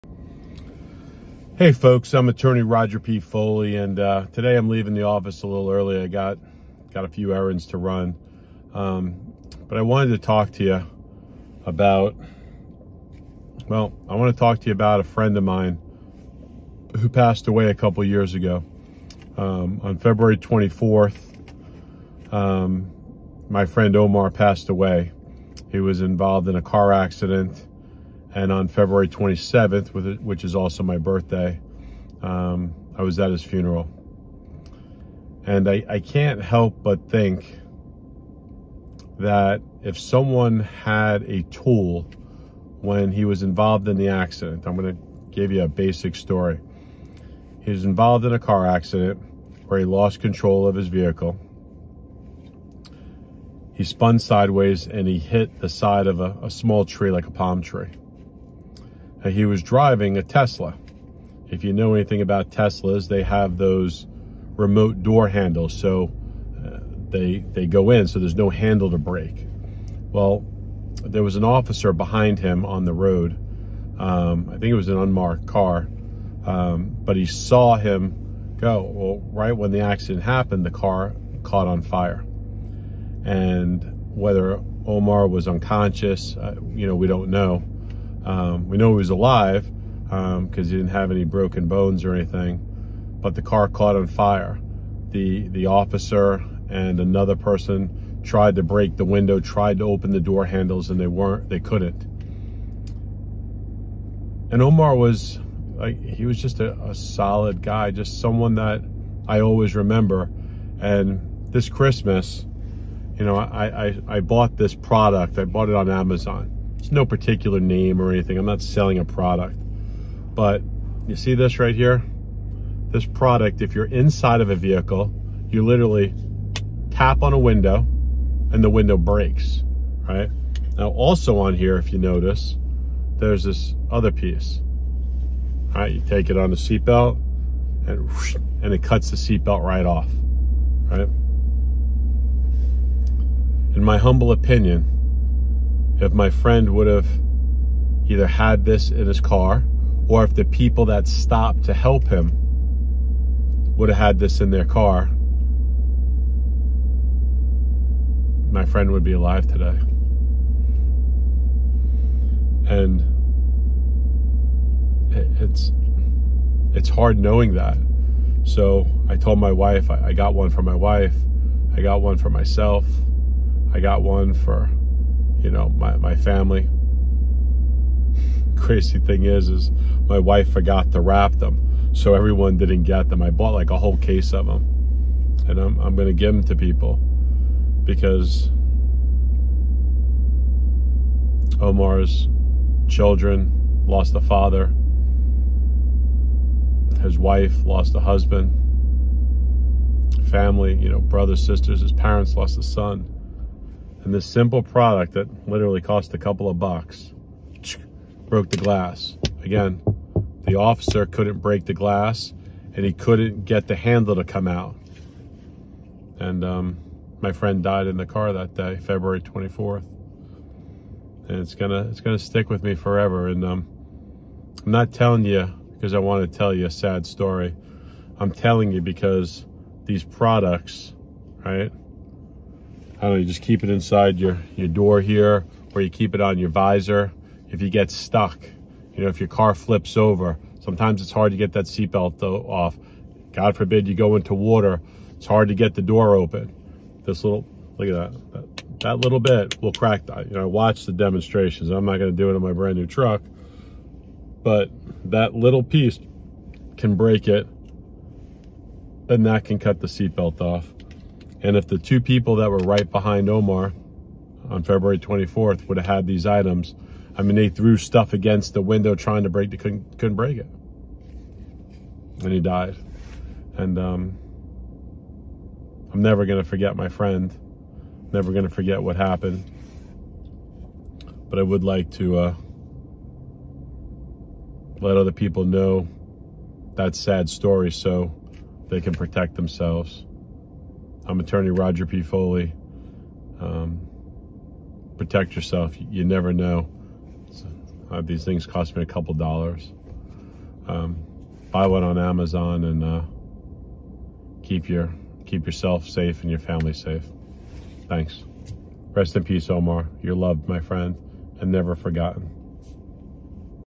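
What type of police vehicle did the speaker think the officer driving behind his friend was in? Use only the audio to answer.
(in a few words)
unmarked car.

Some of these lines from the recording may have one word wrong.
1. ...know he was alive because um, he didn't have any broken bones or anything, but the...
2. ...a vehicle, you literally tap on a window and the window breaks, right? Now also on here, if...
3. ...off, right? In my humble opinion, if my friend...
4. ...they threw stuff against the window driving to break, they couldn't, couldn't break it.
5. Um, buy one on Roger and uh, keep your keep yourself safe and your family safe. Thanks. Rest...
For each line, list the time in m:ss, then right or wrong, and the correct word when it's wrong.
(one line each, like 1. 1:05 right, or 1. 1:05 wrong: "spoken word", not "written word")
1. 1:28 right
2. 2:04 right
3. 2:19 right
4. 4:27 wrong: "trying", not "driving"
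5. 5:00 wrong: "Amazon", not "Roger".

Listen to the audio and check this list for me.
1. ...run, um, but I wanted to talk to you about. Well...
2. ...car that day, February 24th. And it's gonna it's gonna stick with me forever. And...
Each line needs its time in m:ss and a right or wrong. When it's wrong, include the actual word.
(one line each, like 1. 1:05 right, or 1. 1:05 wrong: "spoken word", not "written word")
1. 0:07 right
2. 3:38 right.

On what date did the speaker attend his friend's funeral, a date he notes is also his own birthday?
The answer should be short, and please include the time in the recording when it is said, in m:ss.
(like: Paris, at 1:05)
February 27, at 0:28.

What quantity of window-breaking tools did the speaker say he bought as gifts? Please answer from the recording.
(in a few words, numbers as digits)
a whole case.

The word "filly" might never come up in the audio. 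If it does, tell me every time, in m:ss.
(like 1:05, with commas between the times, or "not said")
not said.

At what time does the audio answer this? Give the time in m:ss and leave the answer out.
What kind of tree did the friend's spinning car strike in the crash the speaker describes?
0:57.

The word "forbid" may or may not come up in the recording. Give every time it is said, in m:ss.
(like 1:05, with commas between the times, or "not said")
4:03.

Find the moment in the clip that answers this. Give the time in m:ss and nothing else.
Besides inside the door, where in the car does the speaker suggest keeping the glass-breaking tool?
3:56.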